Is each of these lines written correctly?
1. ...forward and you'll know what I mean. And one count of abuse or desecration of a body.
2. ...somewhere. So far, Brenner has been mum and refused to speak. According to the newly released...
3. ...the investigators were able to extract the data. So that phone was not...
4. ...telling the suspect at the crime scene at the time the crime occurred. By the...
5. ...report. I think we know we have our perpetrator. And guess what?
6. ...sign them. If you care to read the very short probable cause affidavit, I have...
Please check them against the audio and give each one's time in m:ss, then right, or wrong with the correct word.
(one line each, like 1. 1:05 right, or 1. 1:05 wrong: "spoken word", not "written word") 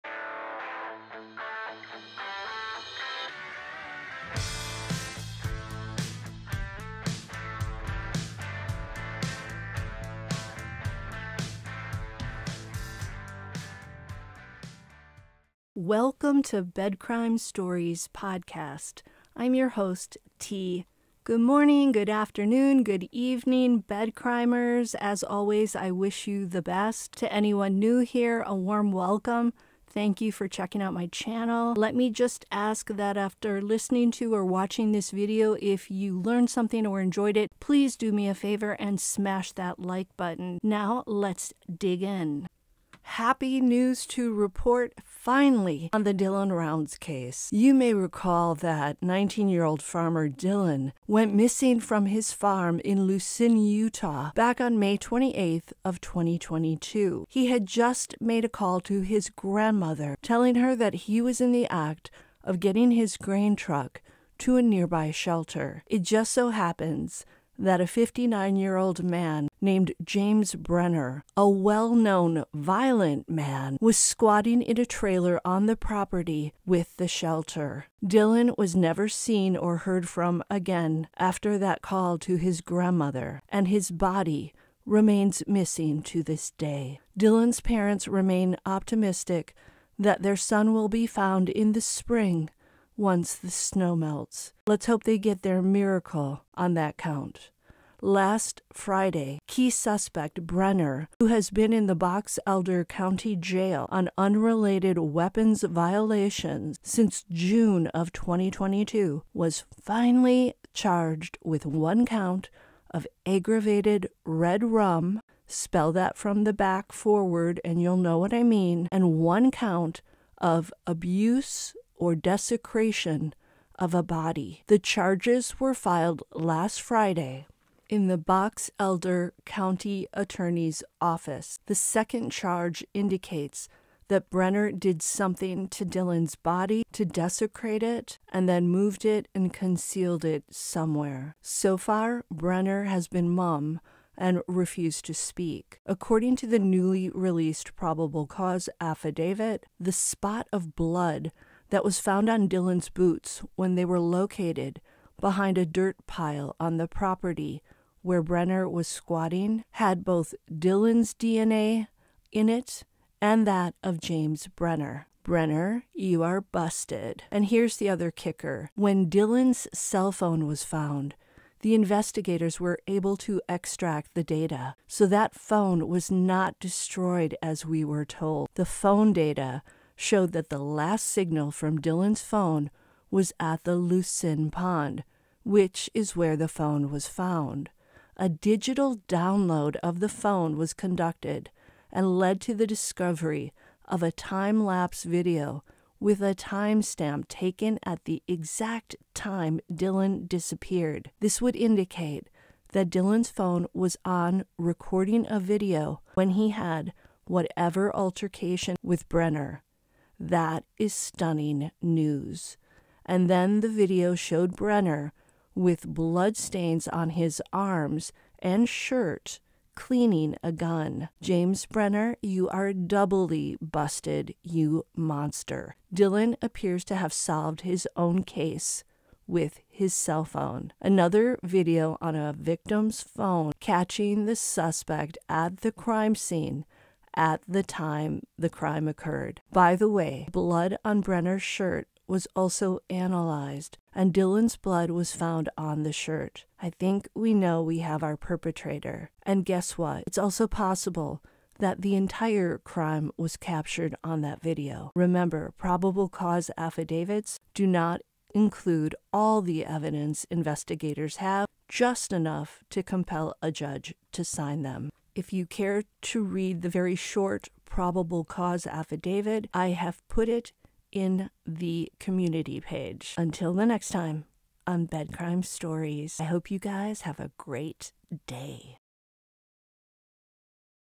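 1. 1:56 right
2. 2:20 right
3. 2:51 right
4. 3:53 wrong: "catching", not "telling"
5. 4:05 wrong: "shirt", not "report"
6. 4:24 right.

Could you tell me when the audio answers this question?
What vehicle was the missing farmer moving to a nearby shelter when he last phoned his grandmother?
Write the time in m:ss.
1:03.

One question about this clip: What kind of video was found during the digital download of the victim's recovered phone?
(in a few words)
Time lapse video.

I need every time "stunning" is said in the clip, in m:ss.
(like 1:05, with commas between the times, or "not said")
3:30.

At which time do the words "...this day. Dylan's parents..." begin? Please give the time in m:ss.
1:26.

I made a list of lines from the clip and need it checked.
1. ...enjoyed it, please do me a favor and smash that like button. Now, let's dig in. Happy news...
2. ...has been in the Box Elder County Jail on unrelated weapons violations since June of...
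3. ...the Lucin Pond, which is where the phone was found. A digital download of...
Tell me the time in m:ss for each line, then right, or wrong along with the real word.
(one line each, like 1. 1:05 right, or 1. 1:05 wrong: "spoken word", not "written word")
1. 0:36 right
2. 1:41 right
3. 3:03 right.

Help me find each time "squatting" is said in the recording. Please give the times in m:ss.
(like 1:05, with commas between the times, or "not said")
1:13, 2:38.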